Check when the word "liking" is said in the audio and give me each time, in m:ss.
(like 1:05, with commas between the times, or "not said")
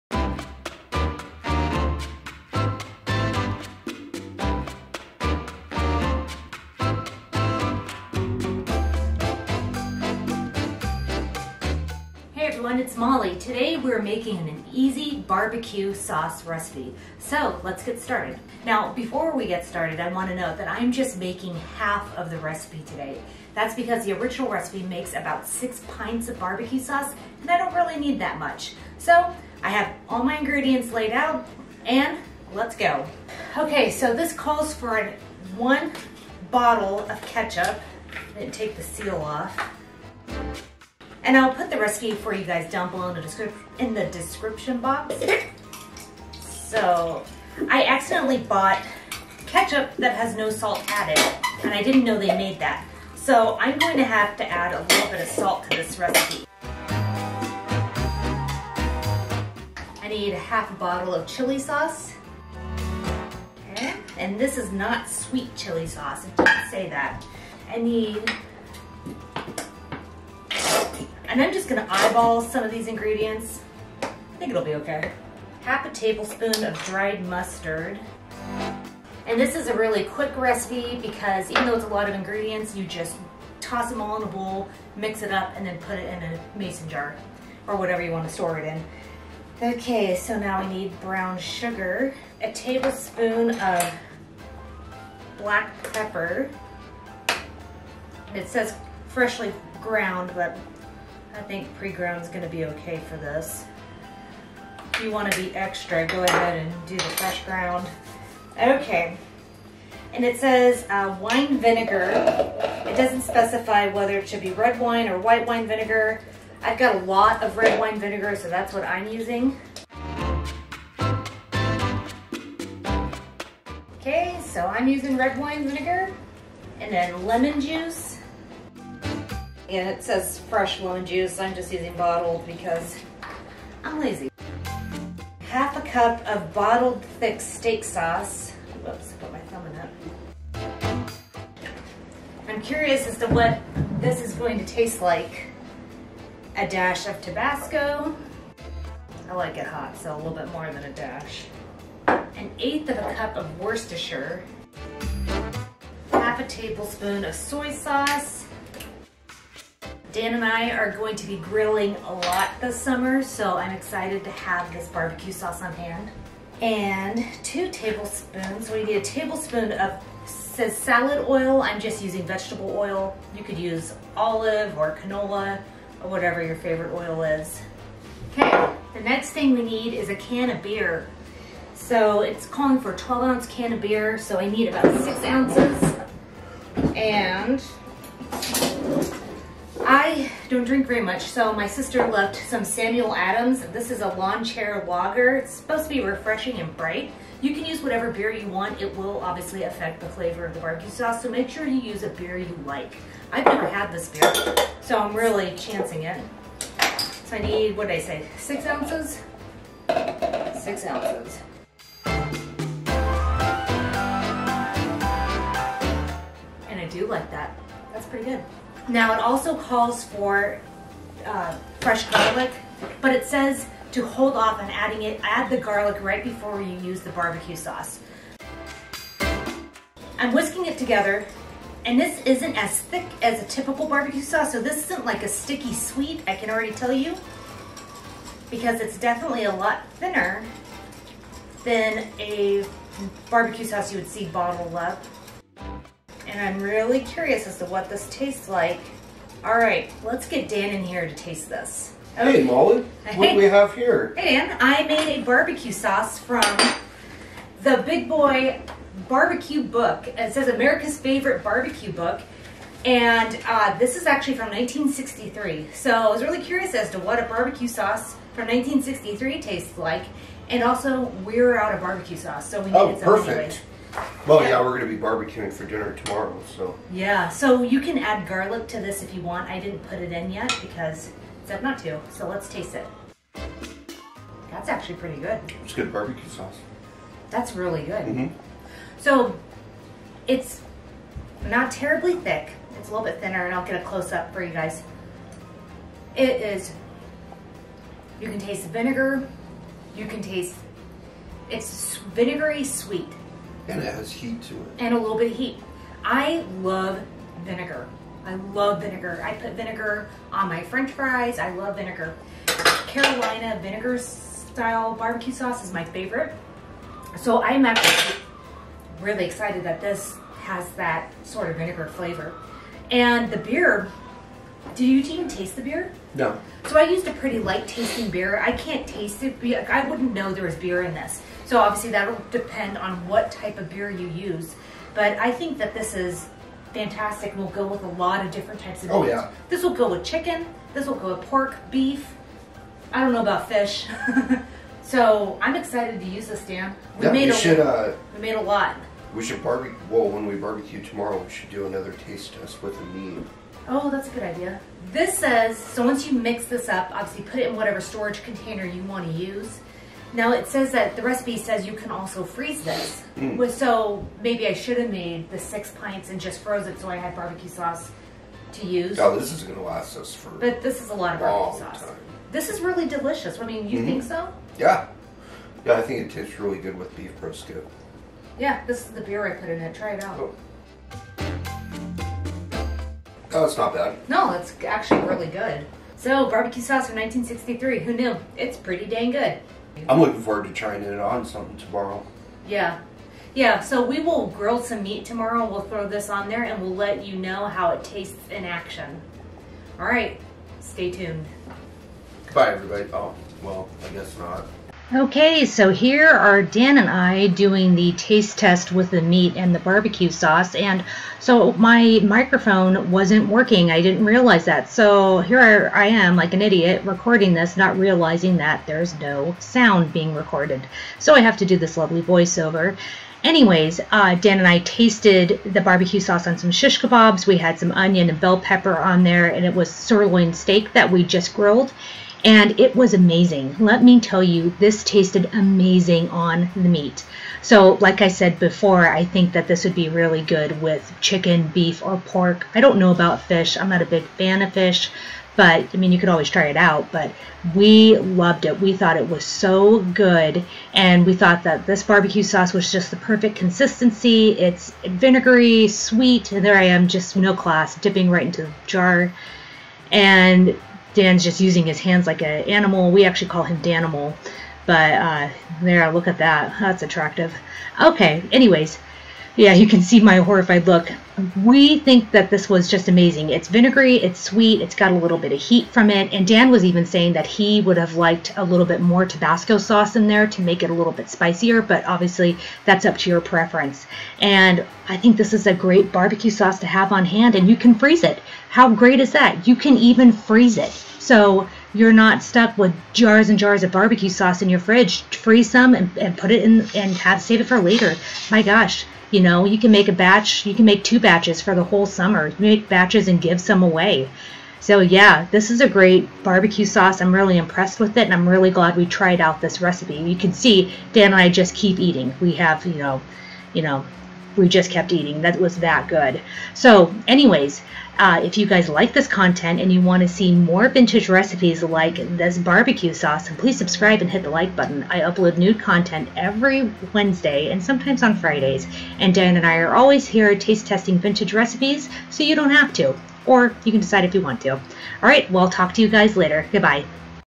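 not said.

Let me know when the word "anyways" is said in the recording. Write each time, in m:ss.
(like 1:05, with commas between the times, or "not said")
7:03, 7:48, 8:37.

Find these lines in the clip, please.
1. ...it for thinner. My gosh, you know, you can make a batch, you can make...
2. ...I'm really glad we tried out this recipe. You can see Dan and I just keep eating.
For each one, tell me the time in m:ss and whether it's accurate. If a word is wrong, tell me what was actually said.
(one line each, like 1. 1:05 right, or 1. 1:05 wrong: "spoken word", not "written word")
1. 8:17 wrong: "later", not "thinner"
2. 8:28 right.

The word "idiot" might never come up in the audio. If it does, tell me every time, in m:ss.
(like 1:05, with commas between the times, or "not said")
6:56.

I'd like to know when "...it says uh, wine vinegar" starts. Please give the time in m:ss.
1:50.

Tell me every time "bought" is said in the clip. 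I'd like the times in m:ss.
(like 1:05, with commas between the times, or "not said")
0:48.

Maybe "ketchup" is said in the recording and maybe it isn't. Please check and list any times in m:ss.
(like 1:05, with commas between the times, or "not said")
0:37, 0:49.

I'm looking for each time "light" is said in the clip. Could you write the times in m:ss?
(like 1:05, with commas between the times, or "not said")
5:27.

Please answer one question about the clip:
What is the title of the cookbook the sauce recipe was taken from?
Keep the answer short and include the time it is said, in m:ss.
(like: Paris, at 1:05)
Big Boy Barbecue Book, at 4:17.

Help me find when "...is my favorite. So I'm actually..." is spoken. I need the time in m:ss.
5:15.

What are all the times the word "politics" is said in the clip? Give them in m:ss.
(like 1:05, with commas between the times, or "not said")
not said.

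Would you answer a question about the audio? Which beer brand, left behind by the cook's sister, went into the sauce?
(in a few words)
Samuel Adams.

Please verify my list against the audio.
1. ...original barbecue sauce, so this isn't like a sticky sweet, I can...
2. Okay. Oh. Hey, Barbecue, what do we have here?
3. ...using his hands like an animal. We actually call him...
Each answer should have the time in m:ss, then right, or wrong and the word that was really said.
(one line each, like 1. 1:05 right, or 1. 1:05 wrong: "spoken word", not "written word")
1. 3:53 wrong: "typical", not "original"
2. 4:12 wrong: "Molly", not "Barbecue"
3. 7:41 right.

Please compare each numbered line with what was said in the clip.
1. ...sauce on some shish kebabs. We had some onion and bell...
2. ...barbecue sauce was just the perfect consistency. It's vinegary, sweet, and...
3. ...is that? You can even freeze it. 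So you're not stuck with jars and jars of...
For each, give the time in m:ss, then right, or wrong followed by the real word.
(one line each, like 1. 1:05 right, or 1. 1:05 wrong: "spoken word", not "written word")
1. 7:06 right
2. 7:31 right
3. 8:08 right.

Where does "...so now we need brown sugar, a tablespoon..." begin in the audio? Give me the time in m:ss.
1:30.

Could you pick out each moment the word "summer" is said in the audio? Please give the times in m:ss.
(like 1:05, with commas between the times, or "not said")
2:42, 8:21.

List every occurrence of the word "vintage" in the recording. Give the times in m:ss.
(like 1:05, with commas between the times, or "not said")
8:40, 8:50.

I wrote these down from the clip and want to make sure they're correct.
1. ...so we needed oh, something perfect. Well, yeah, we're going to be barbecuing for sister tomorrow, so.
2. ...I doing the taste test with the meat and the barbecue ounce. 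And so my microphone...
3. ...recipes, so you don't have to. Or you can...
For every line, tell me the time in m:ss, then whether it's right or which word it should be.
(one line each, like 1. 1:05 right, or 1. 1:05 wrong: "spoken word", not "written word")
1. 4:32 wrong: "dinner", not "sister"
2. 6:46 wrong: "sauce", not "ounce"
3. 8:51 right.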